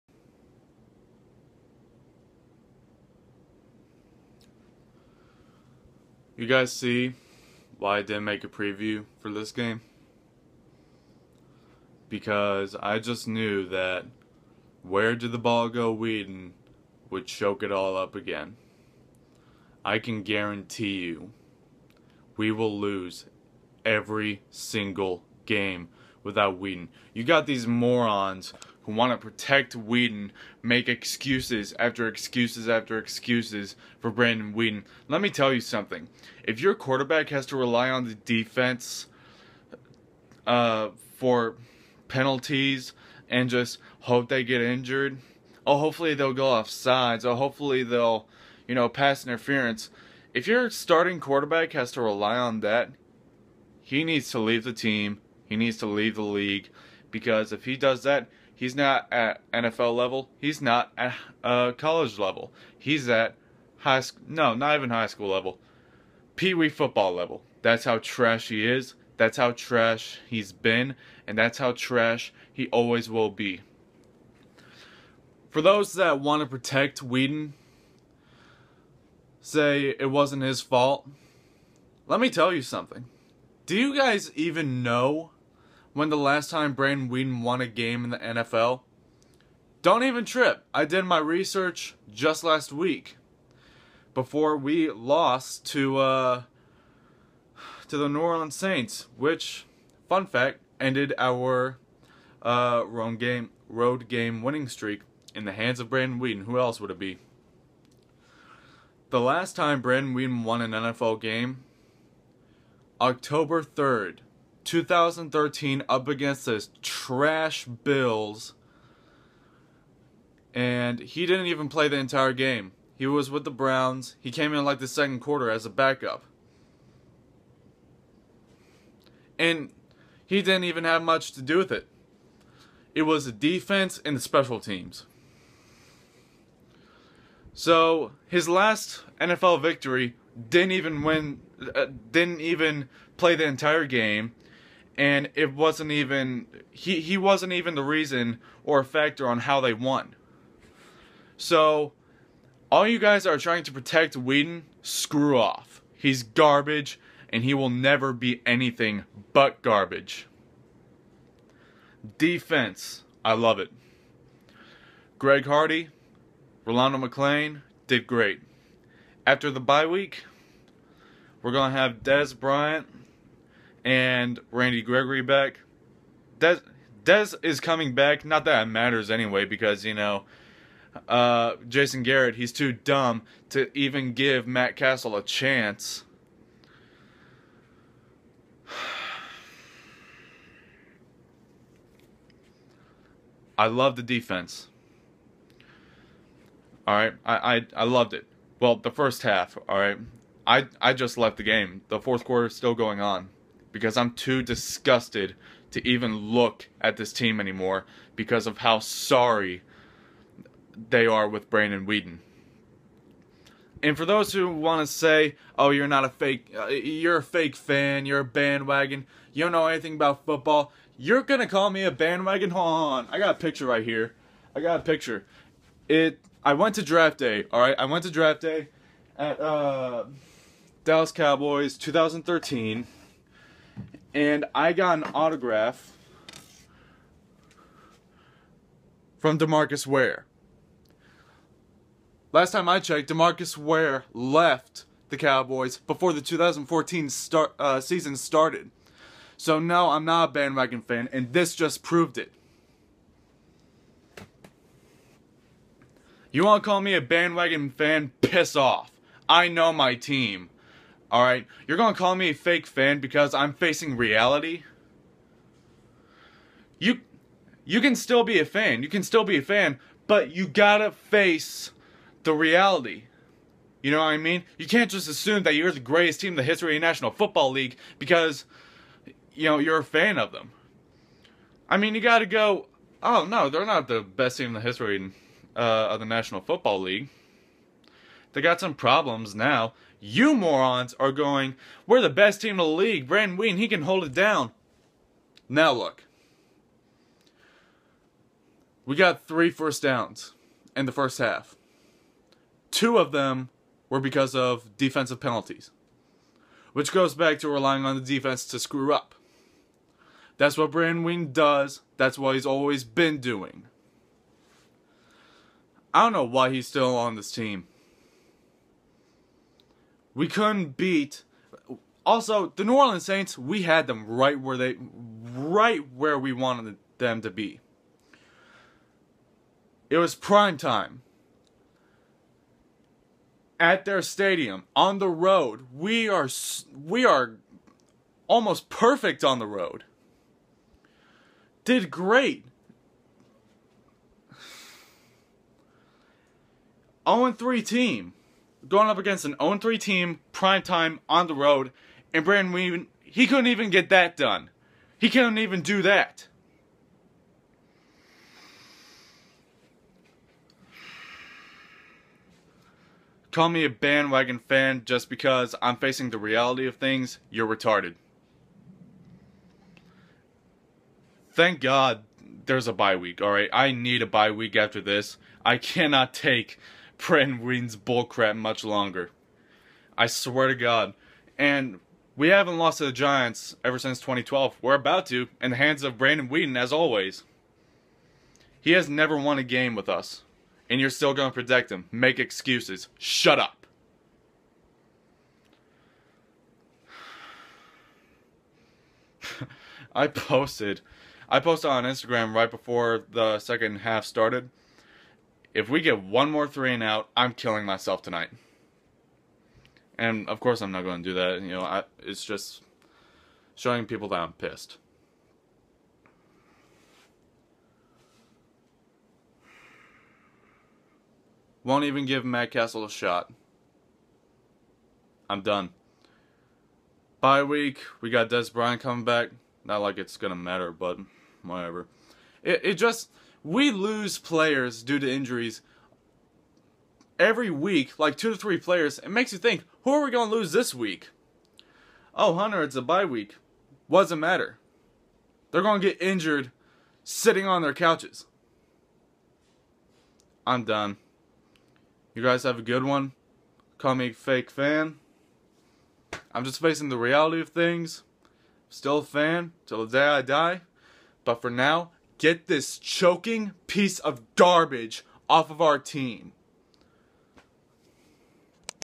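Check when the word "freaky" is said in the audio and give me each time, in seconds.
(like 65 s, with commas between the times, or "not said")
not said.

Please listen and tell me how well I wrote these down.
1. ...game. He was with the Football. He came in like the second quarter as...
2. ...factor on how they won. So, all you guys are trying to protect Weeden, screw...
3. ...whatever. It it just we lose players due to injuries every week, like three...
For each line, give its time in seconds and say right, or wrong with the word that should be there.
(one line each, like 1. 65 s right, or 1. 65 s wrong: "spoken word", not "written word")
1. 122 s wrong: "Browns", not "Football"
2. 148 s right
3. 431 s wrong: "two", not "three".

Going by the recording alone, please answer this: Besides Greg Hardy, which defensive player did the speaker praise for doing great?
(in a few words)
Rolando McClain.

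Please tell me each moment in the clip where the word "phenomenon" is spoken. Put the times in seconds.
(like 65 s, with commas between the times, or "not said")
not said.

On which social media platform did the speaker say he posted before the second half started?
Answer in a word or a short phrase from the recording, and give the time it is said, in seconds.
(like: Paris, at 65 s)
Instagram, at 401 s.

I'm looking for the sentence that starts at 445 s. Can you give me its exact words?
They're going to get injured sitting on their couches.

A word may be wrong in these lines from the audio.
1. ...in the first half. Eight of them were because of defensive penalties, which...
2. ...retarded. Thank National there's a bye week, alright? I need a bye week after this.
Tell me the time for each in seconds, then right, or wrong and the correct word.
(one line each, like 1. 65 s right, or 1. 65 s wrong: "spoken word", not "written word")
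1. 300 s wrong: "Two", not "Eight"
2. 367 s wrong: "God", not "National".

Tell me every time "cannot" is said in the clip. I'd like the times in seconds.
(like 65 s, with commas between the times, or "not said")
375 s.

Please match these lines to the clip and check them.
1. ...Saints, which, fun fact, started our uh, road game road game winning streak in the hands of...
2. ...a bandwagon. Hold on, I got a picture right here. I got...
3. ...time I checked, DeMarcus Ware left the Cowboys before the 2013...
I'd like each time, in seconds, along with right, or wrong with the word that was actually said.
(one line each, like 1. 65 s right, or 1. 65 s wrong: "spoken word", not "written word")
1. 98 s wrong: "ended", not "started"
2. 221 s right
3. 242 s wrong: "2014", not "2013".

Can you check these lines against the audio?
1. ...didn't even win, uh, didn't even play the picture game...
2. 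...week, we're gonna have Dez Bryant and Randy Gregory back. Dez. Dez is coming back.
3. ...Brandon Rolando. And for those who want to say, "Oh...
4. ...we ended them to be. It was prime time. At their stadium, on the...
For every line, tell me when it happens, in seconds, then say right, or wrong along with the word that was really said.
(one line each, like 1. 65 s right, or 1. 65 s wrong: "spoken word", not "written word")
1. 140 s wrong: "entire", not "picture"
2. 169 s right
3. 211 s wrong: "Weeden", not "Rolando"
4. 326 s wrong: "wanted", not "ended".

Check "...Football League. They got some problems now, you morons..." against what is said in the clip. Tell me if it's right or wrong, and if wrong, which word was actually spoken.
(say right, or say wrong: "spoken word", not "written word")
right.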